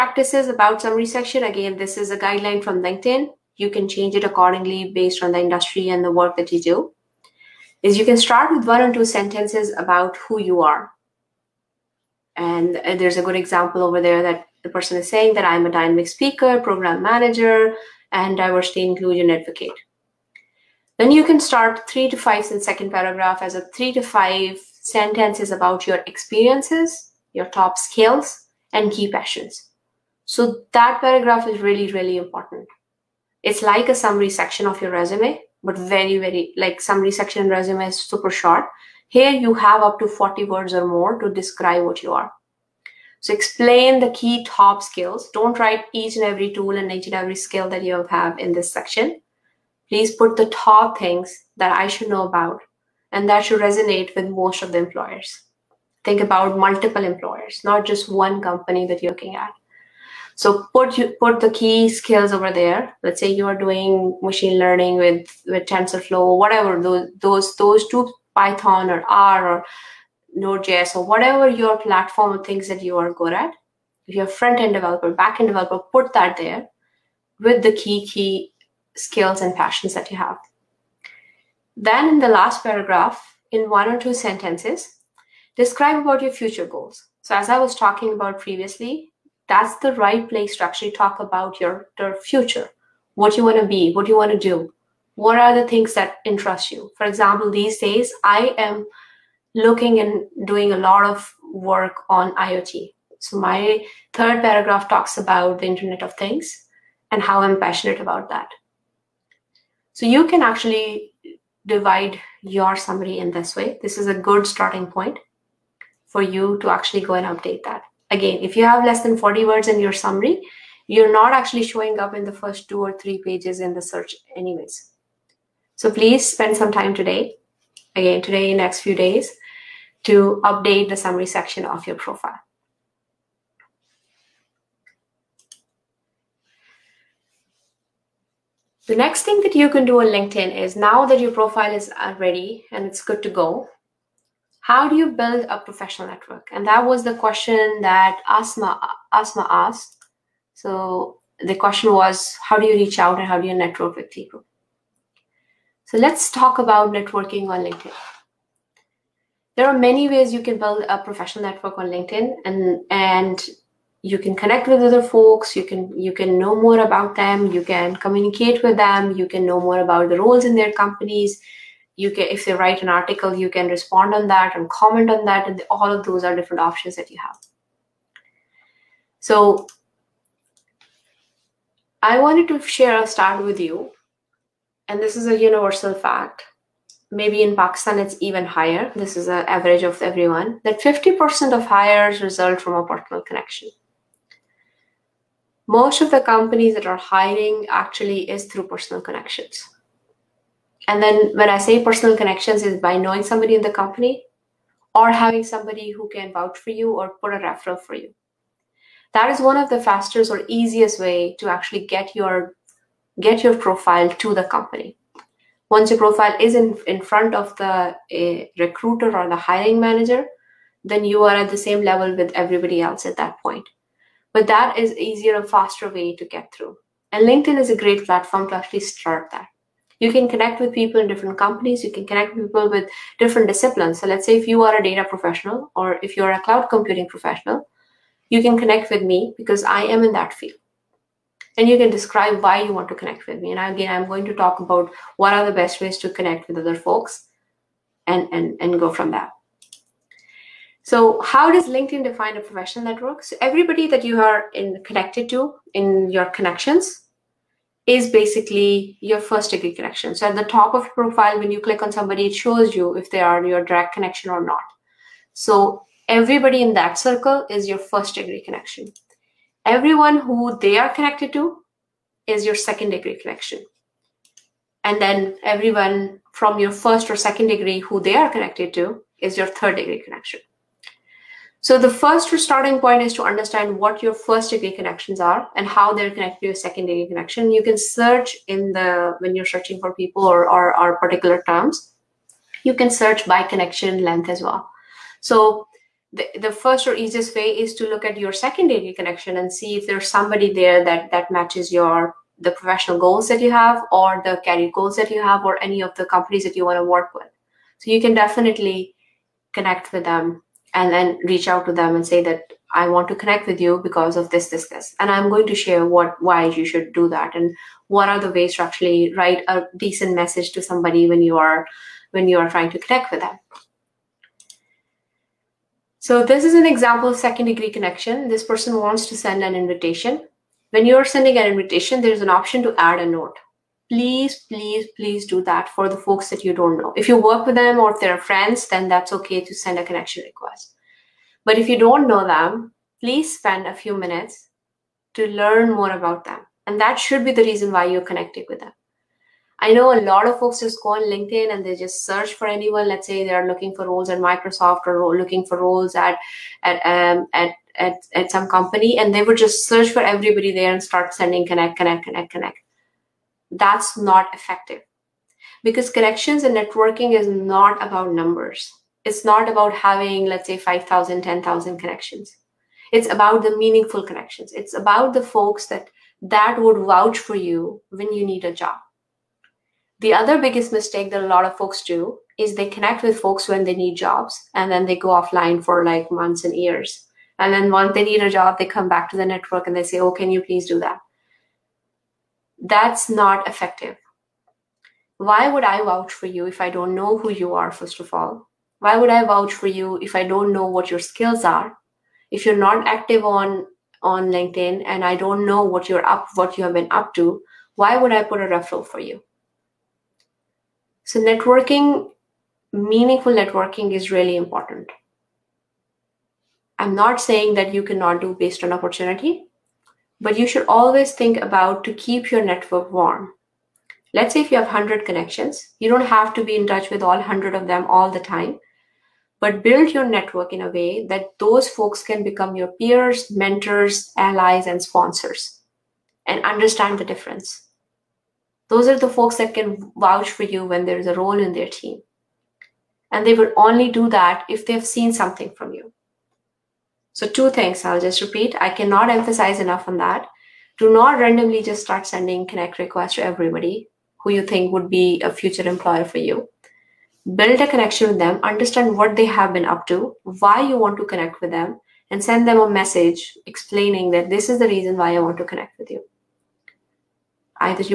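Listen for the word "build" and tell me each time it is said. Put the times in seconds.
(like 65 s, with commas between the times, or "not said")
145 s, 160 s, 429 s, 457 s.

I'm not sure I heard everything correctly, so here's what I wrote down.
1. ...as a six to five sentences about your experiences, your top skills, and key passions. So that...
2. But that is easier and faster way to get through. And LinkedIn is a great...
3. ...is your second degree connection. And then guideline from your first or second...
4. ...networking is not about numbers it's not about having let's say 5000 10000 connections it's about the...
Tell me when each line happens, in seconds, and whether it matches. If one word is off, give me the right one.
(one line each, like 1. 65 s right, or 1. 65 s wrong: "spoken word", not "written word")
1. 23 s wrong: "three", not "six"
2. 224 s right
3. 272 s wrong: "everyone", not "guideline"
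4. 366 s right.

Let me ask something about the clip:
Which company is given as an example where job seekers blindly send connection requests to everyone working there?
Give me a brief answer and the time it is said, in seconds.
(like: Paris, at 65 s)
Microsoft, at 354 s.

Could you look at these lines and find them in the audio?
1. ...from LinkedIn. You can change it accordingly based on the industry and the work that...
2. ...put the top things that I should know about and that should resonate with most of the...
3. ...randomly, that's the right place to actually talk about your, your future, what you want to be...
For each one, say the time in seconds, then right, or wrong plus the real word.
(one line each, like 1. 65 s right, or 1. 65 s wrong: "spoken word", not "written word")
1. 2 s right
2. 50 s right
3. 88 s wrong: "previously", not "randomly".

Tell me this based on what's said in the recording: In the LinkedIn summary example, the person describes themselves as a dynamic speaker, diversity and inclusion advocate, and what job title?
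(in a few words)
program manager.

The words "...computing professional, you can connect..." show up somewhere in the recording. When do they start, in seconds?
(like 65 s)
236 s.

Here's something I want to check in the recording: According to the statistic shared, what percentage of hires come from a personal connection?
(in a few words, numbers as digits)
50%.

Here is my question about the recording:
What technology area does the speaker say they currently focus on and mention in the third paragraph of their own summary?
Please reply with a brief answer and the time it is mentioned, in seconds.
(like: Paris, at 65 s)
IoT, at 102 s.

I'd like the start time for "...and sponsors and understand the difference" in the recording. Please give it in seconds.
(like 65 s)
434 s.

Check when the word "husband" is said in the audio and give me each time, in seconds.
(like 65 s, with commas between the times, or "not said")
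not said.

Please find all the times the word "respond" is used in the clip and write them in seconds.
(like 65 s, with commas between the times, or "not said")
173 s.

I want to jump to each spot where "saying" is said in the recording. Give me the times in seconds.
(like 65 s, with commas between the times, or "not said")
15 s, 417 s.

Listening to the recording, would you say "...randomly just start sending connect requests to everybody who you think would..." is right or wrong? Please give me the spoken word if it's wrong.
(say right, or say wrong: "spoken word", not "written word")
right.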